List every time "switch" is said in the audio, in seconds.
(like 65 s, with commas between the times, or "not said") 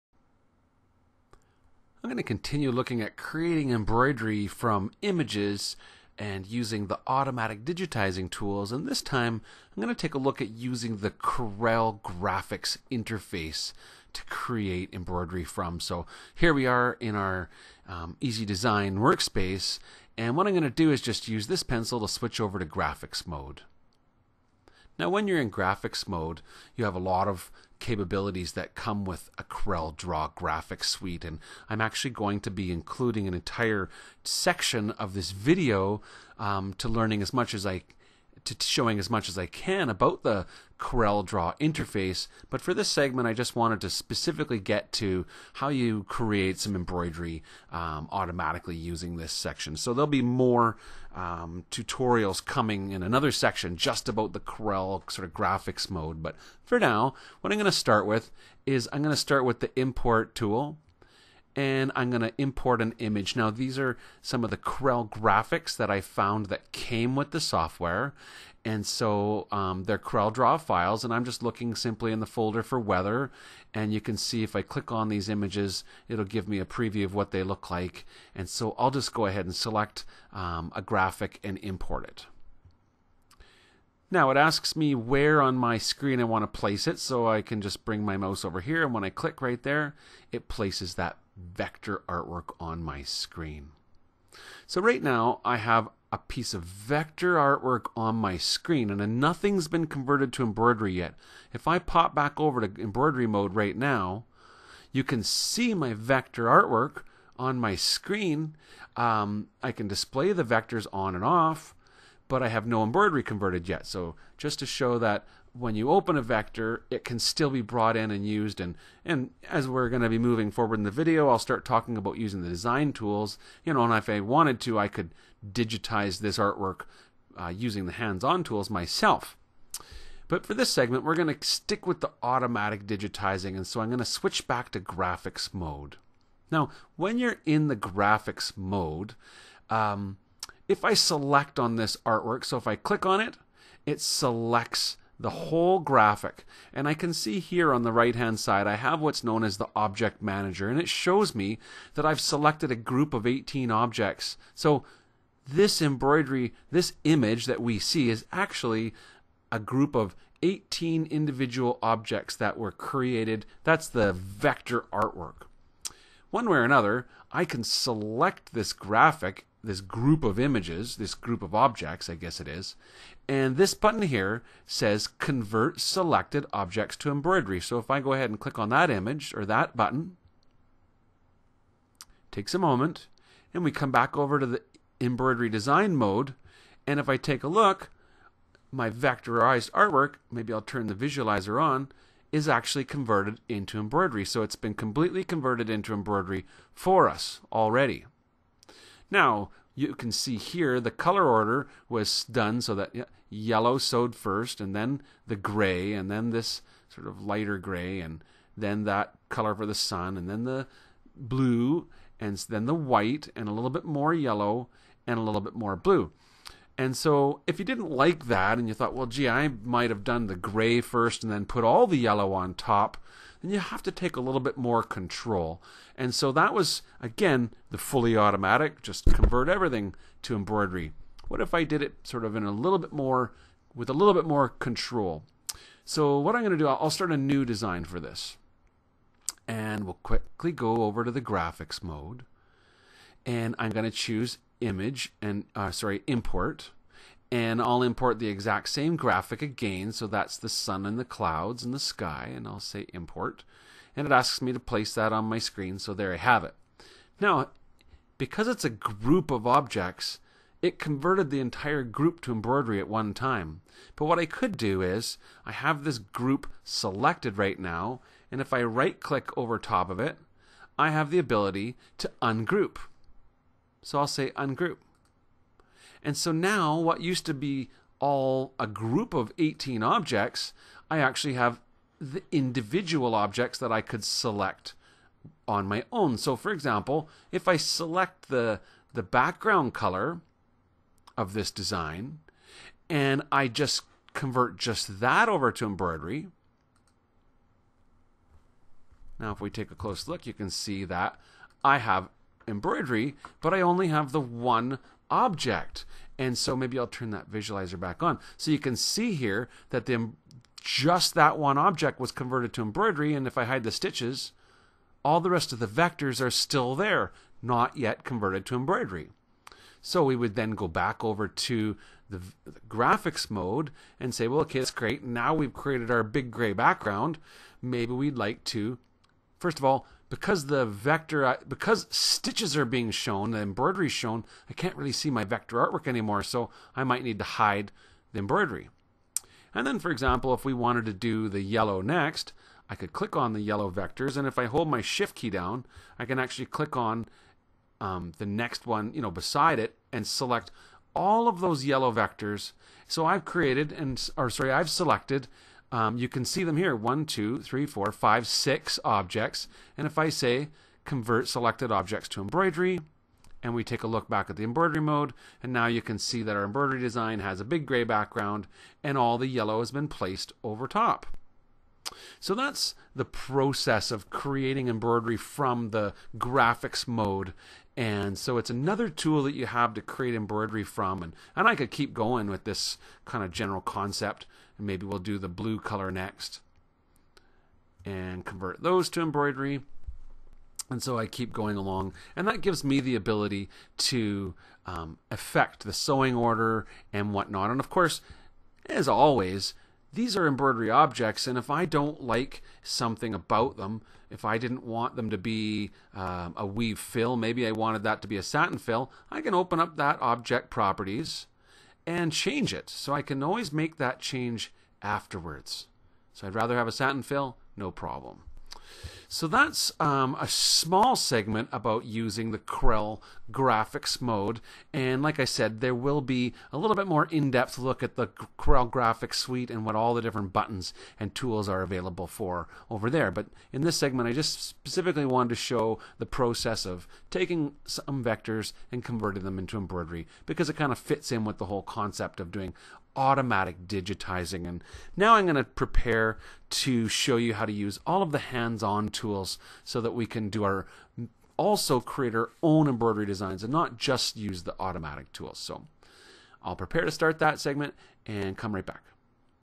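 22 s, 134 s.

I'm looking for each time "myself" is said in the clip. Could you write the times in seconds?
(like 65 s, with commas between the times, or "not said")
128 s.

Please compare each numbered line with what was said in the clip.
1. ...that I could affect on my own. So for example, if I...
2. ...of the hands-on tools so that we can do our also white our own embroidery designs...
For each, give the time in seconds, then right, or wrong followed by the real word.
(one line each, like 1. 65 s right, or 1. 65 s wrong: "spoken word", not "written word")
1. 283 s wrong: "select", not "affect"
2. 448 s wrong: "create", not "white".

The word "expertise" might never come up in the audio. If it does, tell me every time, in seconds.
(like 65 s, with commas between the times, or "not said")
not said.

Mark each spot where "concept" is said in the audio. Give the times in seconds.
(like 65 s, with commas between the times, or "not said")
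383 s, 441 s.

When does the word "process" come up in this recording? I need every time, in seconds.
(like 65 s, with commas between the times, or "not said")
373 s, 436 s.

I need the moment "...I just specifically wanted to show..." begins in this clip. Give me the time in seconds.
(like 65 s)
434 s.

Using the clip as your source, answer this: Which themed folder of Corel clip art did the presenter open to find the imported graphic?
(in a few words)
weather.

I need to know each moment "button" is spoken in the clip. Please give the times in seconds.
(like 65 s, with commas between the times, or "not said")
173 s, 179 s, 430 s.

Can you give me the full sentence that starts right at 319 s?
So we would then go back over to the, the graphics mode and say, well, okay, that's great.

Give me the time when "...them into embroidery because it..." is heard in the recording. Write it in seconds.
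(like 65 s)
439 s.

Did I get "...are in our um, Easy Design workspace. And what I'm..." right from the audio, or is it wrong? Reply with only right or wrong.
right.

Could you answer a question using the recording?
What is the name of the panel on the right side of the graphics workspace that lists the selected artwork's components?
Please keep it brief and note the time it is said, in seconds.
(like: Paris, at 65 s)
object manager, at 149 s.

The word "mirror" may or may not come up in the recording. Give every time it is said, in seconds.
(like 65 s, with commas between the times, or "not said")
not said.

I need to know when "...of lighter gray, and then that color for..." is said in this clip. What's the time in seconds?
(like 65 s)
207 s.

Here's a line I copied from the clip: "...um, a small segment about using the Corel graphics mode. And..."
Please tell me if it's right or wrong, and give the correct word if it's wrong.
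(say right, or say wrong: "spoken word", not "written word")
right.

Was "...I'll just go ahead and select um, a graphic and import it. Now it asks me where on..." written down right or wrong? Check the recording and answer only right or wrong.
right.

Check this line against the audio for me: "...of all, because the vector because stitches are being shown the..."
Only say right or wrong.
right.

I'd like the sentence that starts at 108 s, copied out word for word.
Um, I can display the vectors on and off but I have no embroidery converted yet.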